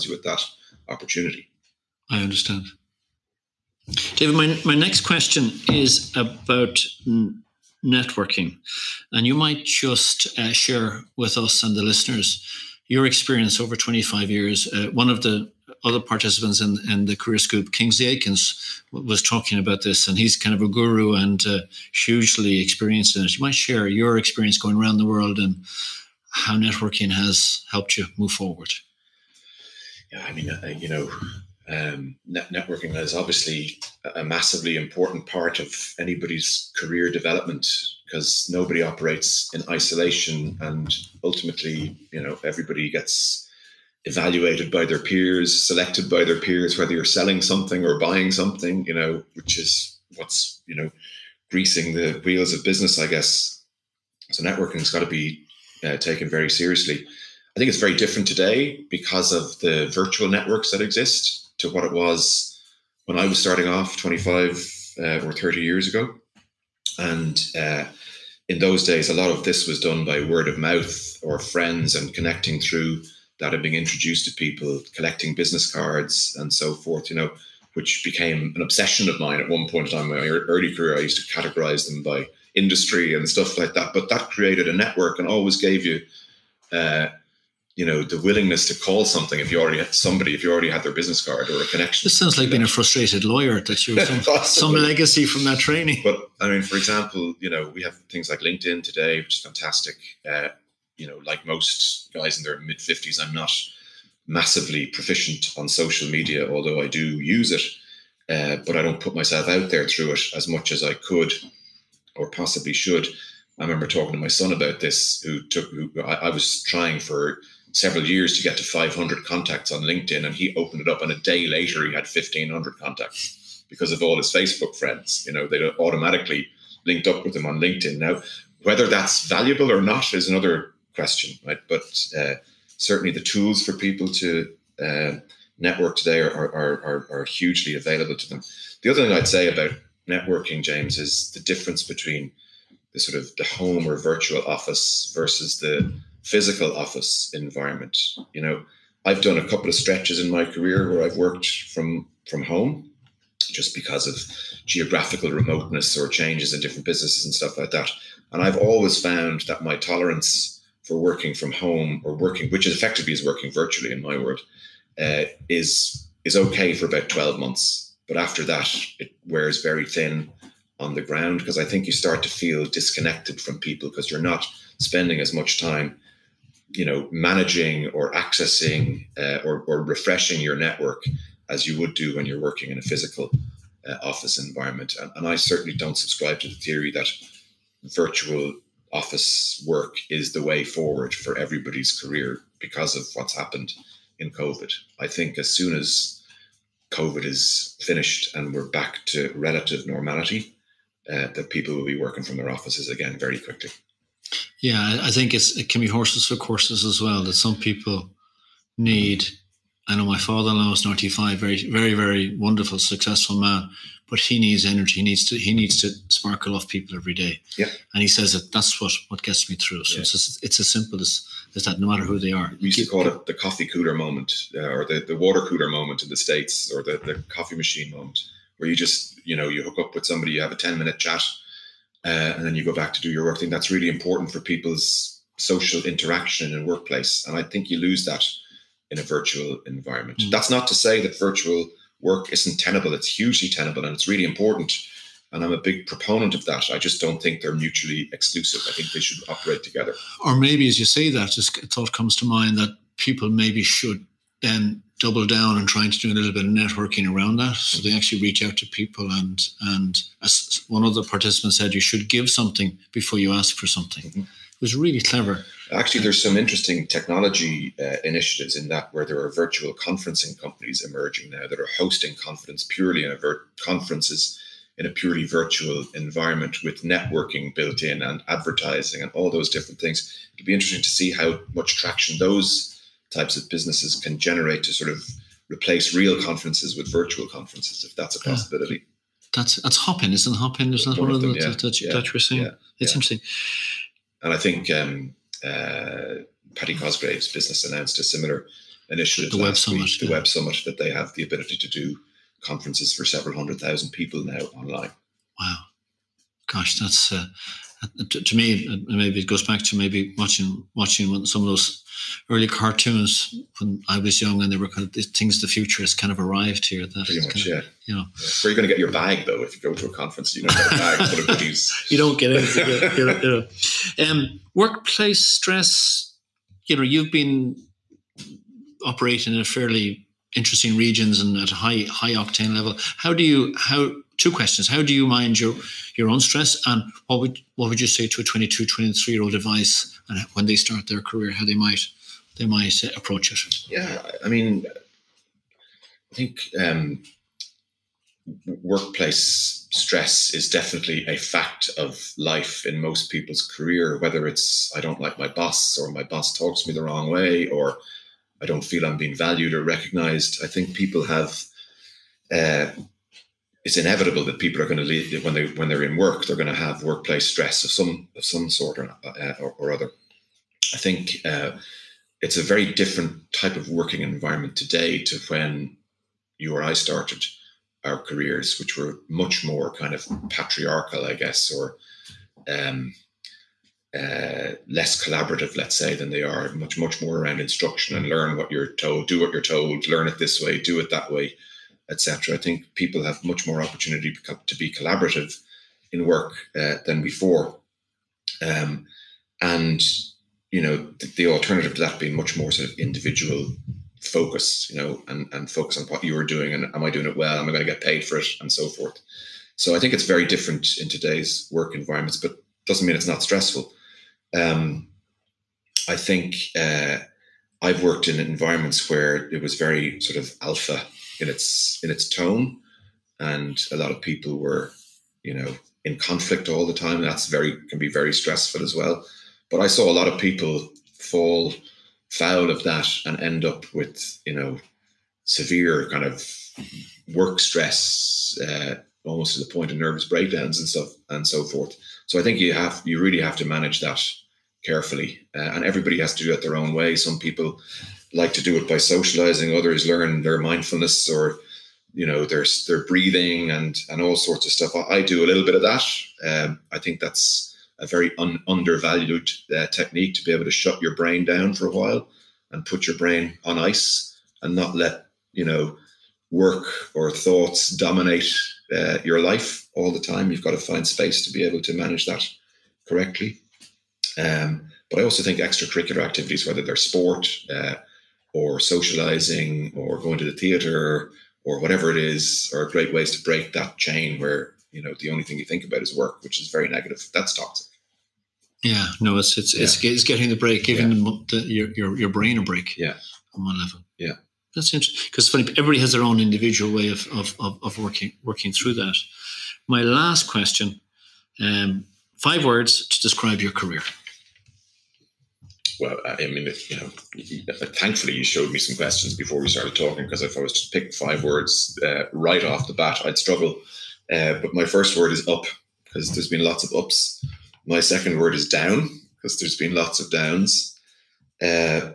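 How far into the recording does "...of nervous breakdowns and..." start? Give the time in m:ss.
7:19.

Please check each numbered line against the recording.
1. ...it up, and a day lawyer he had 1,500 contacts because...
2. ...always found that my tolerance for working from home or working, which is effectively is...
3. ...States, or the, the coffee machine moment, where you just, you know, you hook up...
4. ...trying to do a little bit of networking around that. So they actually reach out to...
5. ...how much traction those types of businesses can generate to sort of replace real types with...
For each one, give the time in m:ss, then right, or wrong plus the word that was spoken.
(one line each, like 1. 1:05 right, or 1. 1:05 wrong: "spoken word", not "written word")
1. 2:00 wrong: "later", not "lawyer"
2. 2:38 right
3. 3:46 right
4. 4:15 right
5. 4:41 wrong: "conferences", not "types".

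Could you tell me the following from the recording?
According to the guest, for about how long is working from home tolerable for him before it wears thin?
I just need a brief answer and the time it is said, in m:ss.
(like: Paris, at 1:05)
12 months, at 2:47.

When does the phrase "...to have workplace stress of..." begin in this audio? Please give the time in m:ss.
6:06.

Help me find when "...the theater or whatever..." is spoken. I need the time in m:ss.
8:00.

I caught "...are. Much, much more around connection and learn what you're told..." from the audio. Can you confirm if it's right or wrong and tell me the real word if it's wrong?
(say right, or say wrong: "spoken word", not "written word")
wrong: "instruction", not "connection".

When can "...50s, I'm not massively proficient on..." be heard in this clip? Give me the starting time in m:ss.
1:42.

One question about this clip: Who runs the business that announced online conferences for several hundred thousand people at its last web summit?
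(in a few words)
Paddy Cosgrave.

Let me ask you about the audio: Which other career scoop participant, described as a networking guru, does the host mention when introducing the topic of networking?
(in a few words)
Kingsley Aikens.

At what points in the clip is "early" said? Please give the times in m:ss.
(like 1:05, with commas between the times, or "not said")
1:20, 5:12.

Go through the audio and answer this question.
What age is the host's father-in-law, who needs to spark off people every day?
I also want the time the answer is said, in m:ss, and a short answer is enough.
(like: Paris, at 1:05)
95, at 3:30.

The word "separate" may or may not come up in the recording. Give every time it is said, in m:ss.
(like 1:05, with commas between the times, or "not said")
not said.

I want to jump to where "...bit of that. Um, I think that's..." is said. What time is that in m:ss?
7:35.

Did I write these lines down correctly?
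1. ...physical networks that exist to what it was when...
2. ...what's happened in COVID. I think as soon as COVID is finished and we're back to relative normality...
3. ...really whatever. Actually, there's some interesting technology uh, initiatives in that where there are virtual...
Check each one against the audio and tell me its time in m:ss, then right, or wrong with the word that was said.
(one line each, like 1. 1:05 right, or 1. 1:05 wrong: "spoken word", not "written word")
1. 0:59 wrong: "virtual", not "physical"
2. 3:13 right
3. 4:24 wrong: "clever", not "whatever".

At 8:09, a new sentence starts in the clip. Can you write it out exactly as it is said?
it's, it's, getting the break giving yeah.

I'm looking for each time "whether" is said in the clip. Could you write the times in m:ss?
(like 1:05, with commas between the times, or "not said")
0:46, 2:08, 5:53, 7:56.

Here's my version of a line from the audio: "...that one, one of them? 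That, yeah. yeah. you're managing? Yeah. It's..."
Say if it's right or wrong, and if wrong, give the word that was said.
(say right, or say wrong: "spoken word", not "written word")
wrong: "saying", not "managing".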